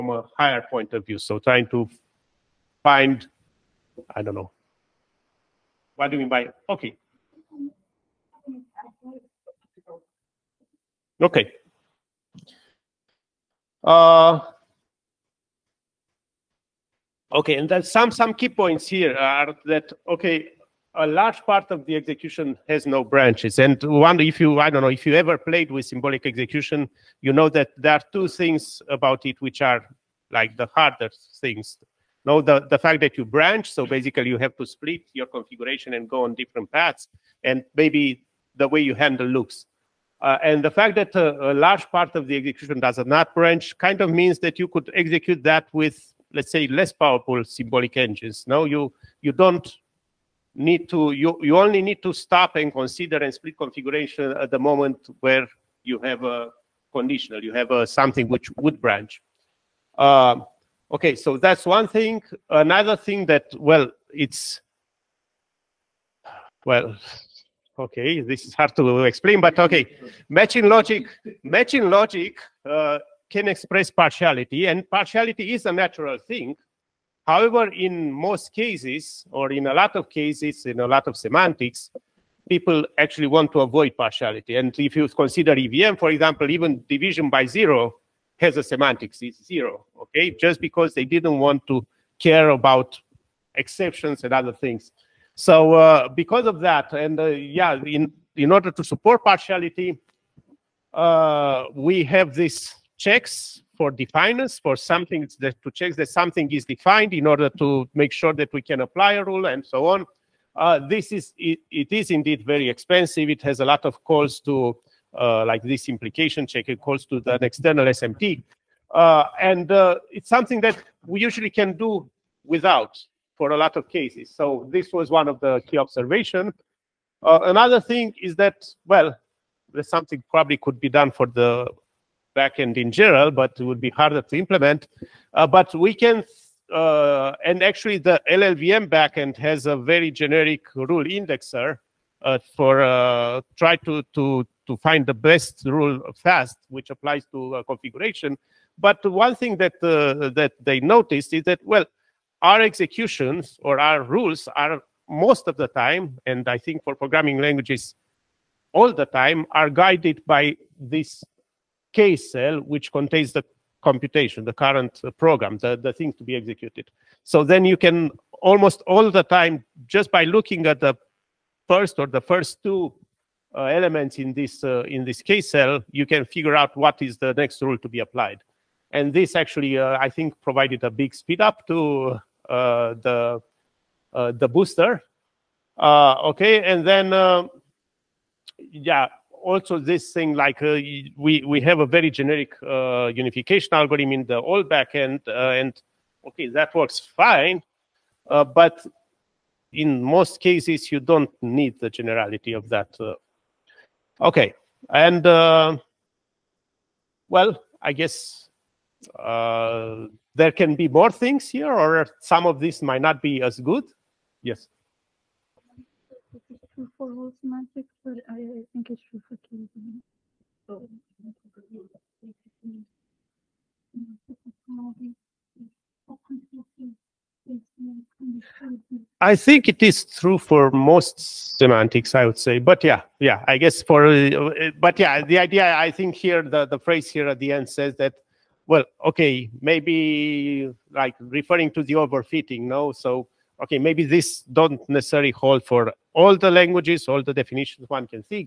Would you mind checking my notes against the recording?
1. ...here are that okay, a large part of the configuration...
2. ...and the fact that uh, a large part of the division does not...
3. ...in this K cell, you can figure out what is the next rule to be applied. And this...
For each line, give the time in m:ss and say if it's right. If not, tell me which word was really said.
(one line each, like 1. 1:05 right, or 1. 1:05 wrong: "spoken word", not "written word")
1. 0:18 wrong: "execution", not "configuration"
2. 0:40 wrong: "execution", not "division"
3. 2:54 right.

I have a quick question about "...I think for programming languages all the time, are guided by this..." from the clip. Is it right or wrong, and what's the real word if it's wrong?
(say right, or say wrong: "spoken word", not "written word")
right.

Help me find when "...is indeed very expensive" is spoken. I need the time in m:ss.
1:51.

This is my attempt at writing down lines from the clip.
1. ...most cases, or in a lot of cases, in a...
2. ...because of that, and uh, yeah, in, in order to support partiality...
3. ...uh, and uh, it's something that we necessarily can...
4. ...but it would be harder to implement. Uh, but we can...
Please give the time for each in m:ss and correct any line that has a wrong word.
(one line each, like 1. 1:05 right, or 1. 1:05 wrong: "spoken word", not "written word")
1. 1:18 right
2. 1:36 right
3. 1:58 wrong: "usually", not "necessarily"
4. 2:13 right.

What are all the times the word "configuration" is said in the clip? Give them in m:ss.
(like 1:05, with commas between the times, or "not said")
0:35, 0:53, 2:27.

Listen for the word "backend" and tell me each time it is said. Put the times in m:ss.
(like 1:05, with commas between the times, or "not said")
2:12, 2:18, 3:14.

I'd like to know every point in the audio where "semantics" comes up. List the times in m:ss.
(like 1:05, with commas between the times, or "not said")
1:21, 1:28, 3:37, 3:51.